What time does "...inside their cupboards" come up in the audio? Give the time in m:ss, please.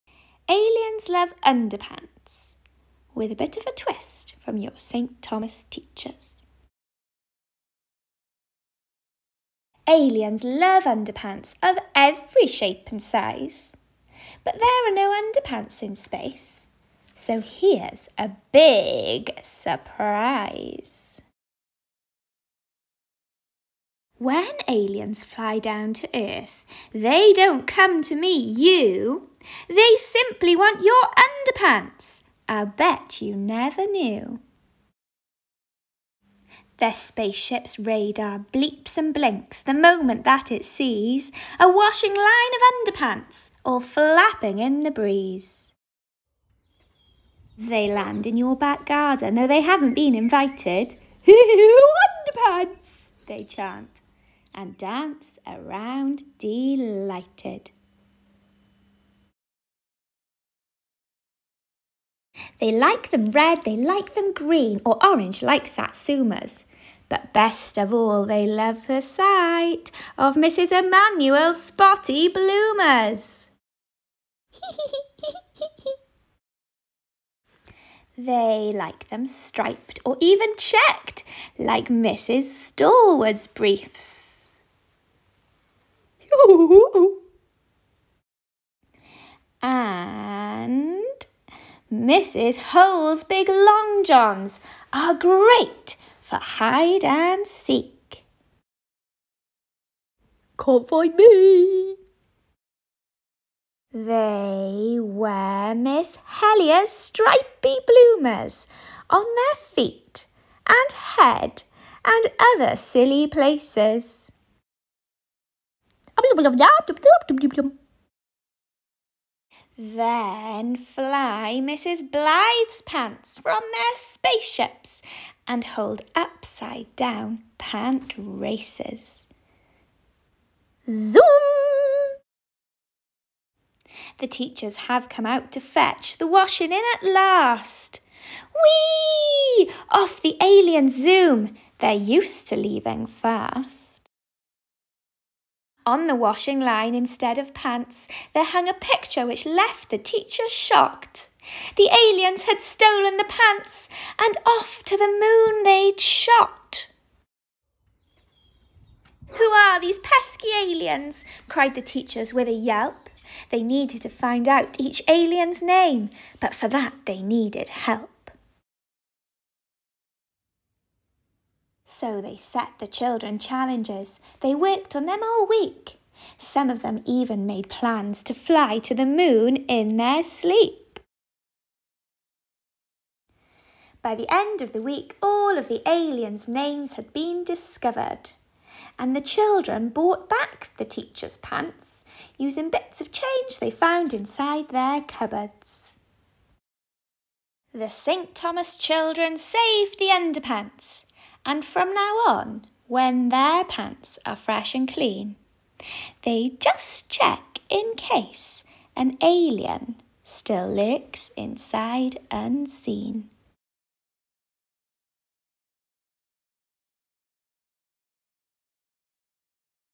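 3:14.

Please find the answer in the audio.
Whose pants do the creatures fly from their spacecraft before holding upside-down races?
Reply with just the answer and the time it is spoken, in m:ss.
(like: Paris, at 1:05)
Mrs. Blythe, at 2:01.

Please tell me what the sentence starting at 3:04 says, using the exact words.
By the end of the week, all of the aliens' names had been discovered.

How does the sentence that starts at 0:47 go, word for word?
They land in your back garden, though they haven't been invited.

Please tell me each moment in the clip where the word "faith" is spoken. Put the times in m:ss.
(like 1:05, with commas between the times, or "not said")
not said.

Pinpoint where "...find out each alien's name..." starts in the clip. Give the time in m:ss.
2:44.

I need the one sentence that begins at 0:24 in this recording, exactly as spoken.
When aliens fly down to Earth, they don't come to meet you.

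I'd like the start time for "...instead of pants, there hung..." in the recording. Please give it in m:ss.
2:26.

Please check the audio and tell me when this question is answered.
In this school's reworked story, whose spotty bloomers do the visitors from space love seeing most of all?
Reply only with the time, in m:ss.
1:10.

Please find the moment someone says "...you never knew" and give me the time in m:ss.
0:33.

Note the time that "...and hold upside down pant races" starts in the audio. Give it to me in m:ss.
2:05.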